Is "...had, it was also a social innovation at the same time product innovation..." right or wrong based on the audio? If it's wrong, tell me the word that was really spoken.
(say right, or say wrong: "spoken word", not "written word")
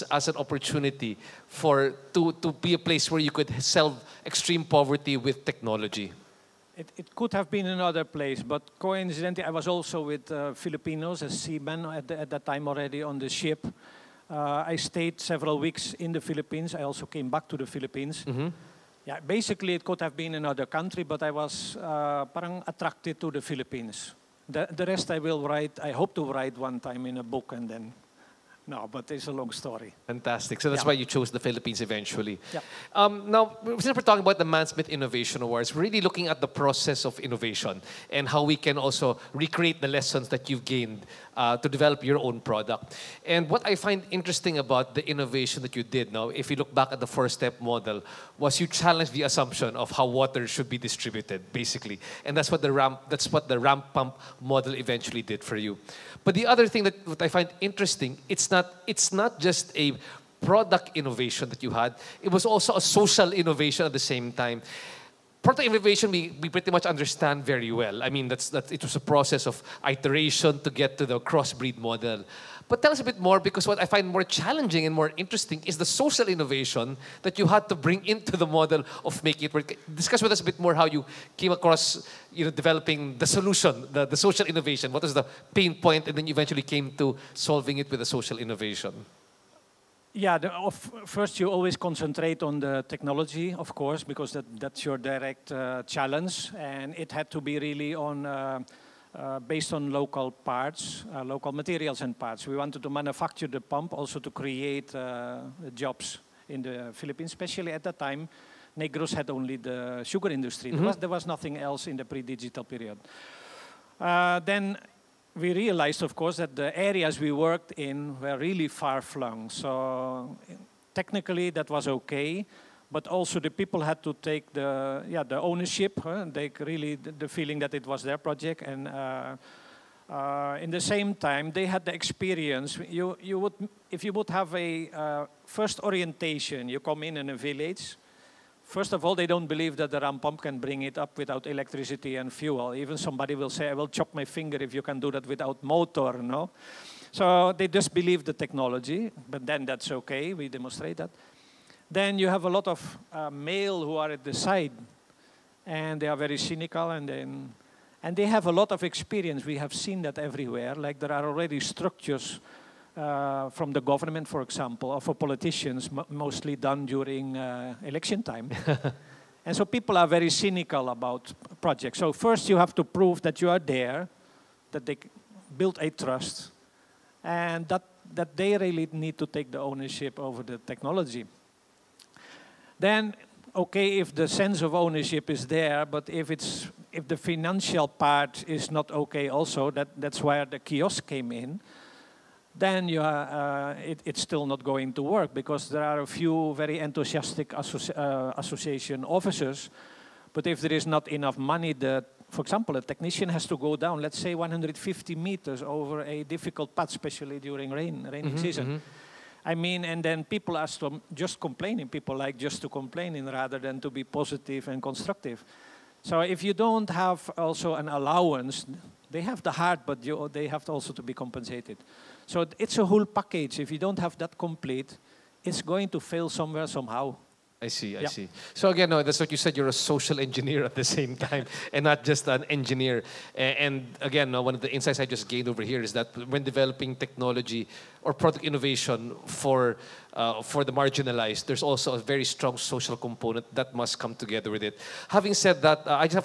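right.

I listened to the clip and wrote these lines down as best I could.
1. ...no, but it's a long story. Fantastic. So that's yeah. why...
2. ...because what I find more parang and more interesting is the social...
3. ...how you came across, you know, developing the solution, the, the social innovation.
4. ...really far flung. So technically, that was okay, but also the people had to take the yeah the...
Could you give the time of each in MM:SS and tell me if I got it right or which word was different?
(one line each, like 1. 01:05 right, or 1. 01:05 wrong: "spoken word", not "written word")
1. 00:28 right
2. 01:13 wrong: "challenging", not "parang"
3. 01:20 right
4. 01:58 right.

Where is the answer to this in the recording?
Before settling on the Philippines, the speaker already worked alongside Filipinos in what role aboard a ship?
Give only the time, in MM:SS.
00:11.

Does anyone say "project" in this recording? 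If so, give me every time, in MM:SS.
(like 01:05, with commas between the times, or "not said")
02:08, 02:51.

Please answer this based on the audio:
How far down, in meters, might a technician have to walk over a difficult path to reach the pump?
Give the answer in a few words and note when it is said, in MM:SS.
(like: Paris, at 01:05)
150 meters, at 03:24.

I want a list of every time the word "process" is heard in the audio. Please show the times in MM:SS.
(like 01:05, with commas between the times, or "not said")
00:36, 01:09.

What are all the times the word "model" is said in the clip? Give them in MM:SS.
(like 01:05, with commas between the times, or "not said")
00:47, 00:54, 01:11, 01:18.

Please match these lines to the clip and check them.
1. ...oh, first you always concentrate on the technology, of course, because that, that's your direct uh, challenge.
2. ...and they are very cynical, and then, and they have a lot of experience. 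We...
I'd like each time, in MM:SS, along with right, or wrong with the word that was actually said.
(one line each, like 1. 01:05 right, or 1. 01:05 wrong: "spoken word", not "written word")
1. 01:30 right
2. 02:35 right.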